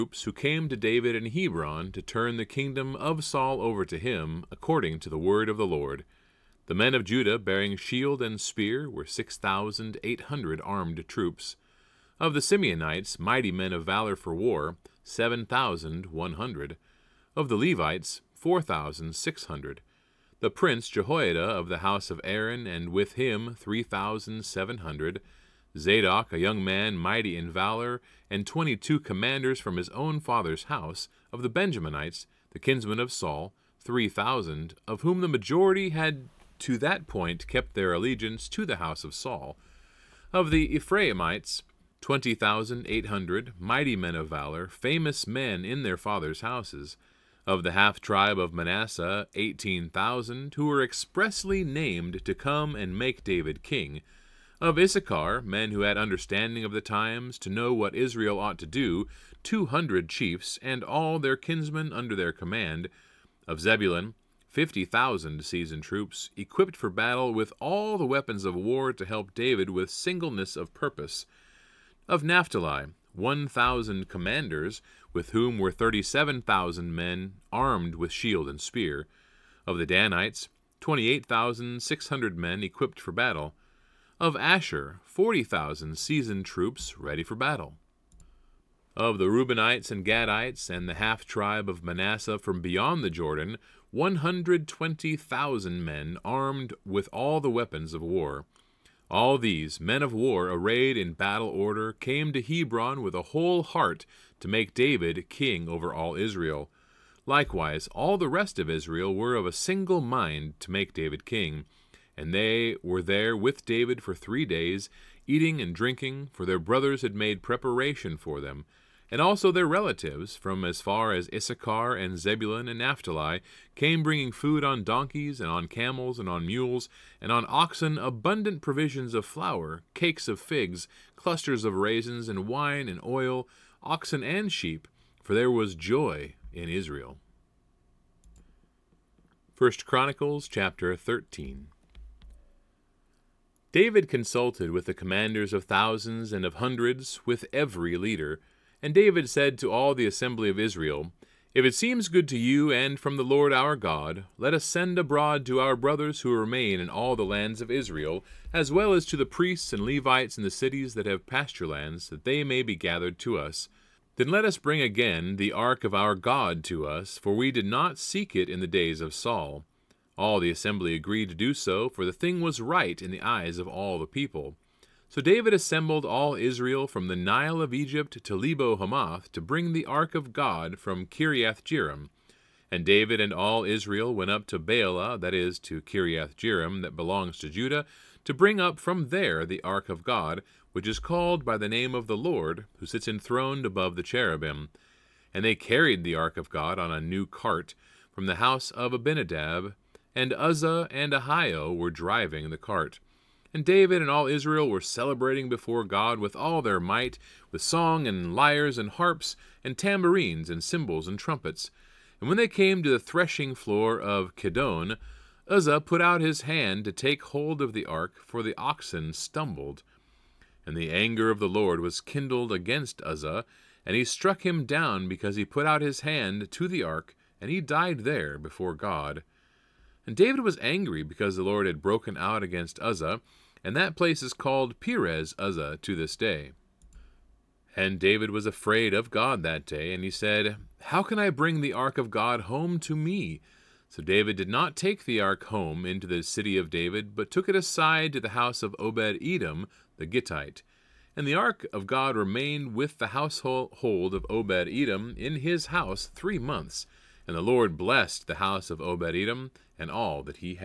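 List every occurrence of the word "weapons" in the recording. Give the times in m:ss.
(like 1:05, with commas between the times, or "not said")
1:08, 1:37.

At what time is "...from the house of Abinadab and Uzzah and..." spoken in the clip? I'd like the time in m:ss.
3:18.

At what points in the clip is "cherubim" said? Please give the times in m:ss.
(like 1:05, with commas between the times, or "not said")
3:14.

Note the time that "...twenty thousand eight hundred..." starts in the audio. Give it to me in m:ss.
0:42.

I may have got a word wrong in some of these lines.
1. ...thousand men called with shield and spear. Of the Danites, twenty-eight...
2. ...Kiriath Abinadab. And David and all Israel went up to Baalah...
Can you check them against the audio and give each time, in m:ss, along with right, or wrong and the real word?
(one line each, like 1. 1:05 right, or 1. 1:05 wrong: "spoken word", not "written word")
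1. 1:16 wrong: "armed", not "called"
2. 3:01 wrong: "Jearim", not "Abinadab".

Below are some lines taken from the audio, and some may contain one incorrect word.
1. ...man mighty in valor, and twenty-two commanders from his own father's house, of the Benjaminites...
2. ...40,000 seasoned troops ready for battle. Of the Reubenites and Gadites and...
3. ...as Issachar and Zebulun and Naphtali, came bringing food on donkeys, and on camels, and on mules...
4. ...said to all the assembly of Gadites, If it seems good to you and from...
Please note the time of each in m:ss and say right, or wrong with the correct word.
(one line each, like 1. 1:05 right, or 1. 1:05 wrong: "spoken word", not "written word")
1. 0:26 right
2. 1:25 right
3. 2:01 right
4. 2:29 wrong: "Israel", not "Gadites".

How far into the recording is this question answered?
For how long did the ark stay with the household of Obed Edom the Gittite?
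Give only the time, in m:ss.
4:16.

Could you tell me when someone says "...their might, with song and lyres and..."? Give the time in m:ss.
3:26.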